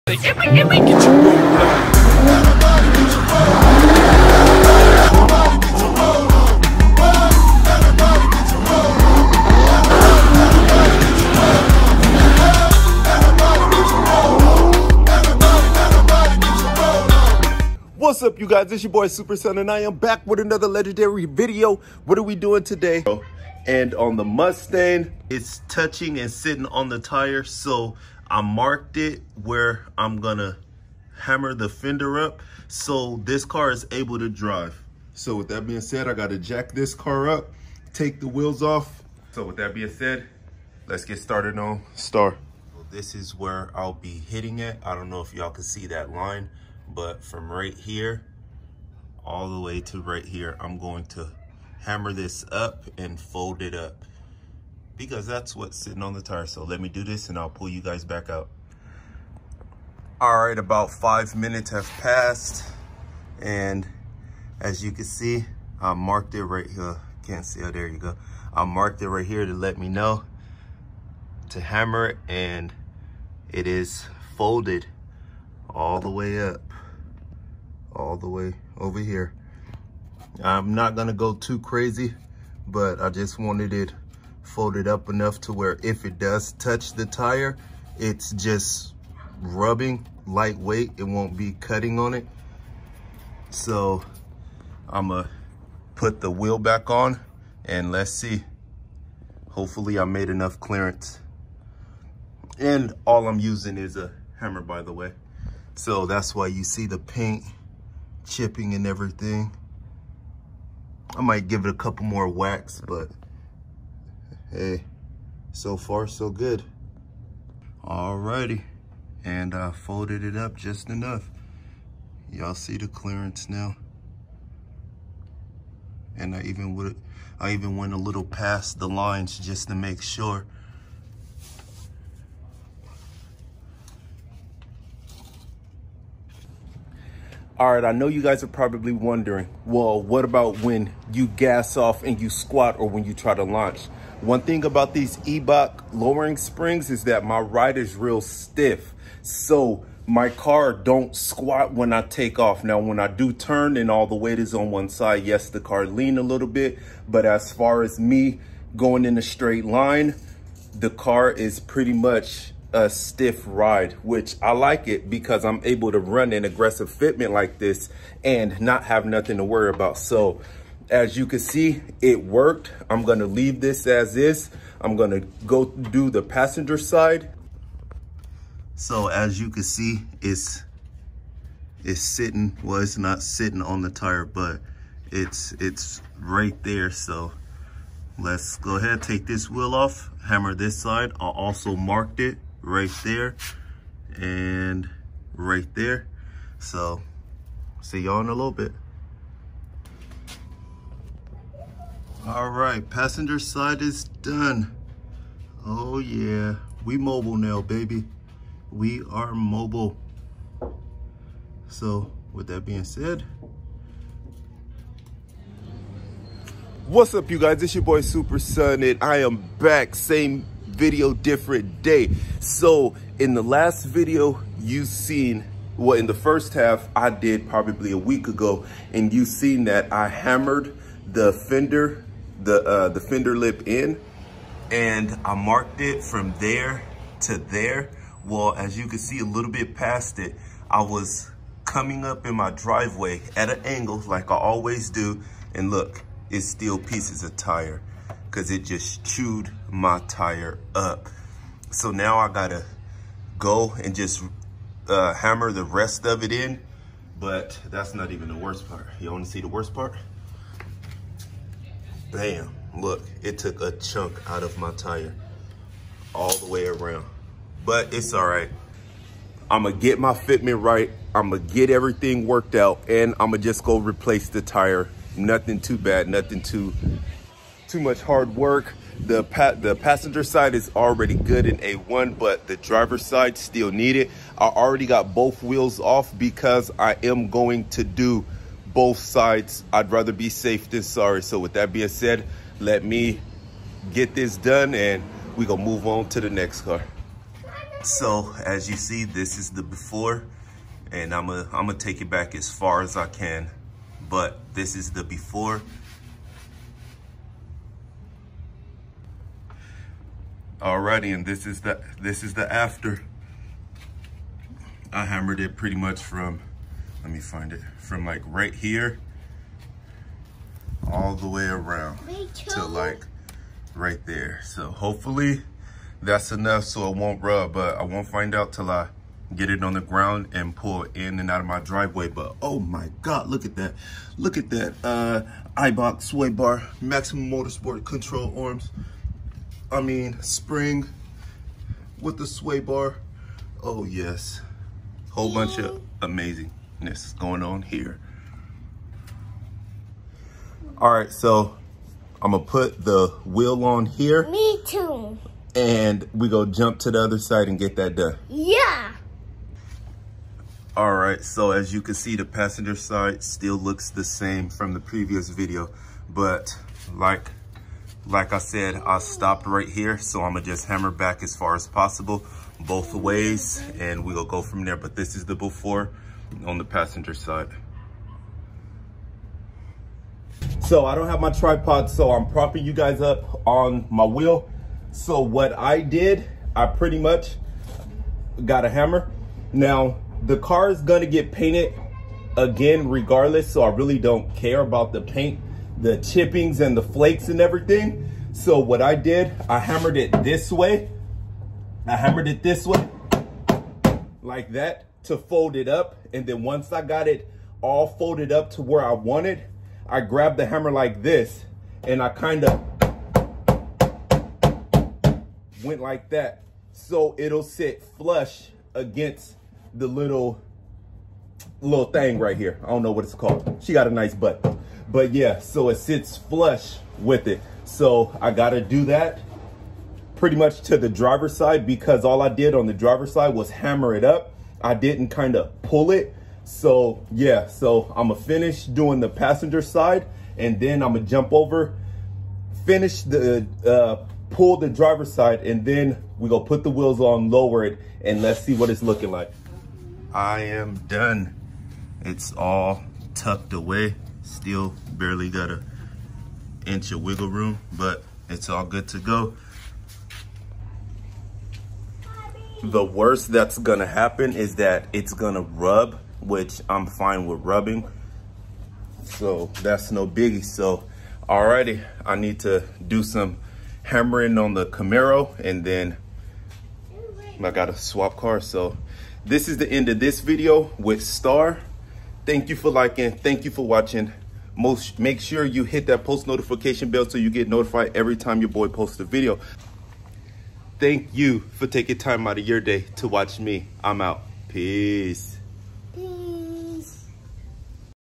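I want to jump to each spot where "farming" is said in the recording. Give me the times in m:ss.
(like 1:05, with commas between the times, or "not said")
not said.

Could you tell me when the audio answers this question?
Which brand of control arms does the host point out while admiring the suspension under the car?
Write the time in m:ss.
5:36.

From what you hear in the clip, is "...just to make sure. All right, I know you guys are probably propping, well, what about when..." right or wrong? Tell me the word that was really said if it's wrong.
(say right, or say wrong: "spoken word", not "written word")
wrong: "wondering", not "propping".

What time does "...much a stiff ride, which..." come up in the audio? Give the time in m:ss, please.
2:41.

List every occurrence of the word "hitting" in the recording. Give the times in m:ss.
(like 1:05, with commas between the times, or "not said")
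0:44.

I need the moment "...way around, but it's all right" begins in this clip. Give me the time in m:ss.
4:26.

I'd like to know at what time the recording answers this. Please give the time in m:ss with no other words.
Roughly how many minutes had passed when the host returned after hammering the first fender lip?
1:00.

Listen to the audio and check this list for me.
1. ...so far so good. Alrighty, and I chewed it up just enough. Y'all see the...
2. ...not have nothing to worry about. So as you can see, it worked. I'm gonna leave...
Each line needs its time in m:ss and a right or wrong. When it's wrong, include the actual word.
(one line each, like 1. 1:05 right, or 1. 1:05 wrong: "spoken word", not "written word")
1. 1:55 wrong: "folded", not "chewed"
2. 2:48 right.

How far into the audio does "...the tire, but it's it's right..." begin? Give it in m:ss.
3:03.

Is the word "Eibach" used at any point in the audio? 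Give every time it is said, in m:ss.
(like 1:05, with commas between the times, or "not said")
2:25, 5:35.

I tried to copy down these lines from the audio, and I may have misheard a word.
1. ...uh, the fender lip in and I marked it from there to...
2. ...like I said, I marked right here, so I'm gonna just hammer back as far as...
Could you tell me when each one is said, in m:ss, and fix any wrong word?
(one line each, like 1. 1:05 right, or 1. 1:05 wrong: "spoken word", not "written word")
1. 3:52 right
2. 6:08 wrong: "stopped", not "marked".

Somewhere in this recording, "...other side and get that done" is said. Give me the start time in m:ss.
5:57.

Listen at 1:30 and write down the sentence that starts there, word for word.
It won't be cutting on it.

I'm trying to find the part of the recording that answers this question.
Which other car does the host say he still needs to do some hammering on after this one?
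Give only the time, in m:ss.
7:54.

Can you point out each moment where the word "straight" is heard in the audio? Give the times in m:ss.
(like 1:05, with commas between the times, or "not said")
2:39.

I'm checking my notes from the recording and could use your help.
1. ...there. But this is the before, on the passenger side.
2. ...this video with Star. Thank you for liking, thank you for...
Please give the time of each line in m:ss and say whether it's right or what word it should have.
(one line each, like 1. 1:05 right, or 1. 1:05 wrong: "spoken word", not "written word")
1. 6:14 right
2. 7:59 right.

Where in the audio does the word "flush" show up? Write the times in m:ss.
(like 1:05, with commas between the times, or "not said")
6:57, 7:06.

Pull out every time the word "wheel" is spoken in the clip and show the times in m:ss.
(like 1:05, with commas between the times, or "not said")
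0:38, 1:36, 3:09, 4:45, 5:53, 6:24, 7:26.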